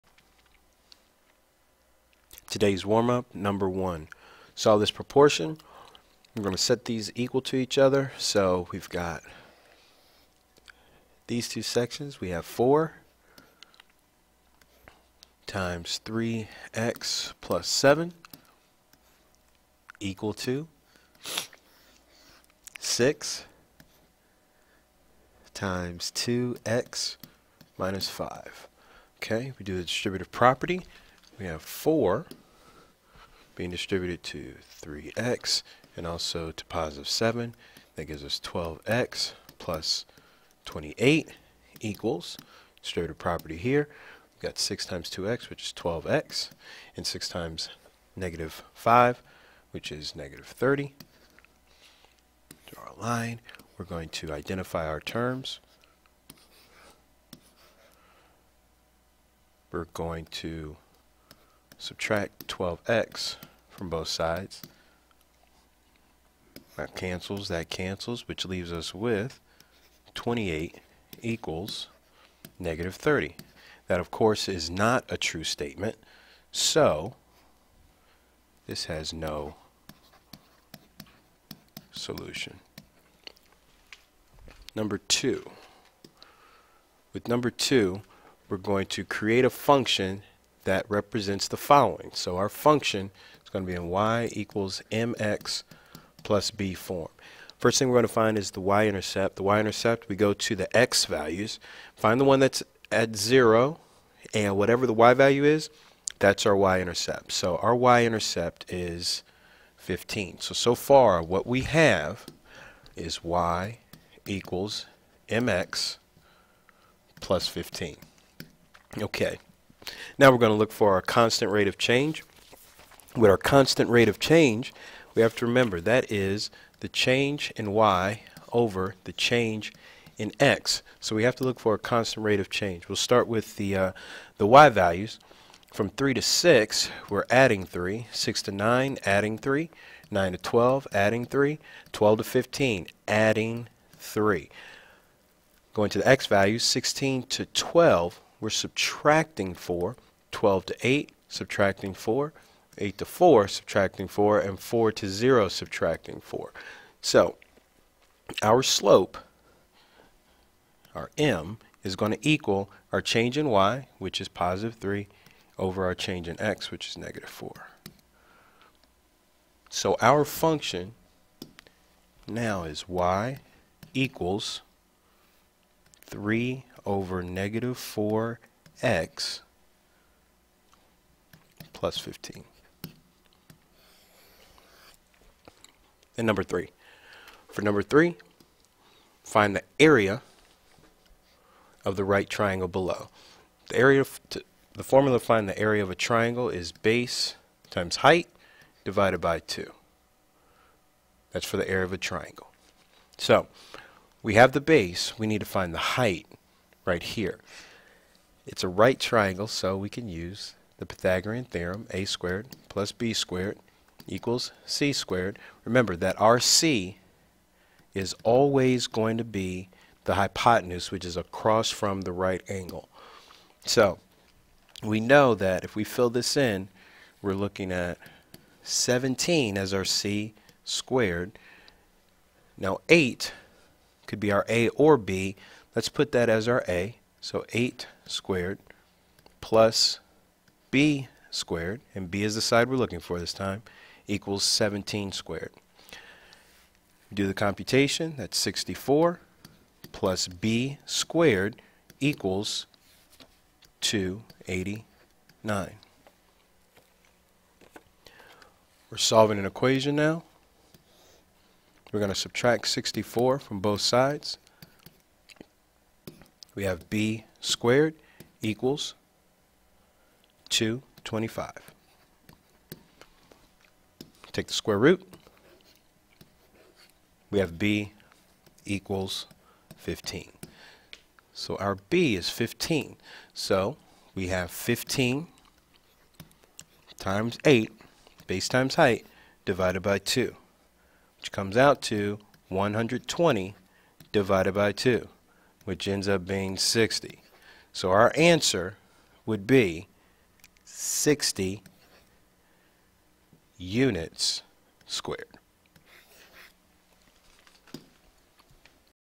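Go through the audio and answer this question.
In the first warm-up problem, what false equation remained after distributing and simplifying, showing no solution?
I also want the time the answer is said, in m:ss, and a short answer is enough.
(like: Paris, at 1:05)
28 equals -30, at 1:10.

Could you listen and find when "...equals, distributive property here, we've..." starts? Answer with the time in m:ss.
0:41.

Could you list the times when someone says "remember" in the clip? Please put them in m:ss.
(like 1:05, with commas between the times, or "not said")
2:05, 3:35.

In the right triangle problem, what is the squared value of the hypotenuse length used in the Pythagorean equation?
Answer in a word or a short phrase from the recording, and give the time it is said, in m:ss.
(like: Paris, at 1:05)
289, at 4:13.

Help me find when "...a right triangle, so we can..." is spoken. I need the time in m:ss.
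3:28.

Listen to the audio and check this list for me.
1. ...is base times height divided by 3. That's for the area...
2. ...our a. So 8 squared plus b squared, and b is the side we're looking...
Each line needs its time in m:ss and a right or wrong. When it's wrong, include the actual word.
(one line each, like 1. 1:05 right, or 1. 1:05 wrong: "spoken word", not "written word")
1. 3:16 wrong: "2", not "3"
2. 3:56 right.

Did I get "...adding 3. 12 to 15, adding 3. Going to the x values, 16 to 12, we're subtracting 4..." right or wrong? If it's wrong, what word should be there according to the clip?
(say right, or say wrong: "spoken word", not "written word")
right.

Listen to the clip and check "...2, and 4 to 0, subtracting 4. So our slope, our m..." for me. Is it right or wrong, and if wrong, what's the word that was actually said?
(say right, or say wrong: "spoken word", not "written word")
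wrong: "4", not "2".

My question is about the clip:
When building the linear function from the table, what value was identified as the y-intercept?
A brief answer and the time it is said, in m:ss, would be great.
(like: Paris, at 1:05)
15, at 1:47.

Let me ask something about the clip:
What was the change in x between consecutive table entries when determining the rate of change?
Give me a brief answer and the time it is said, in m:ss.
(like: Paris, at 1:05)
-4, at 2:46.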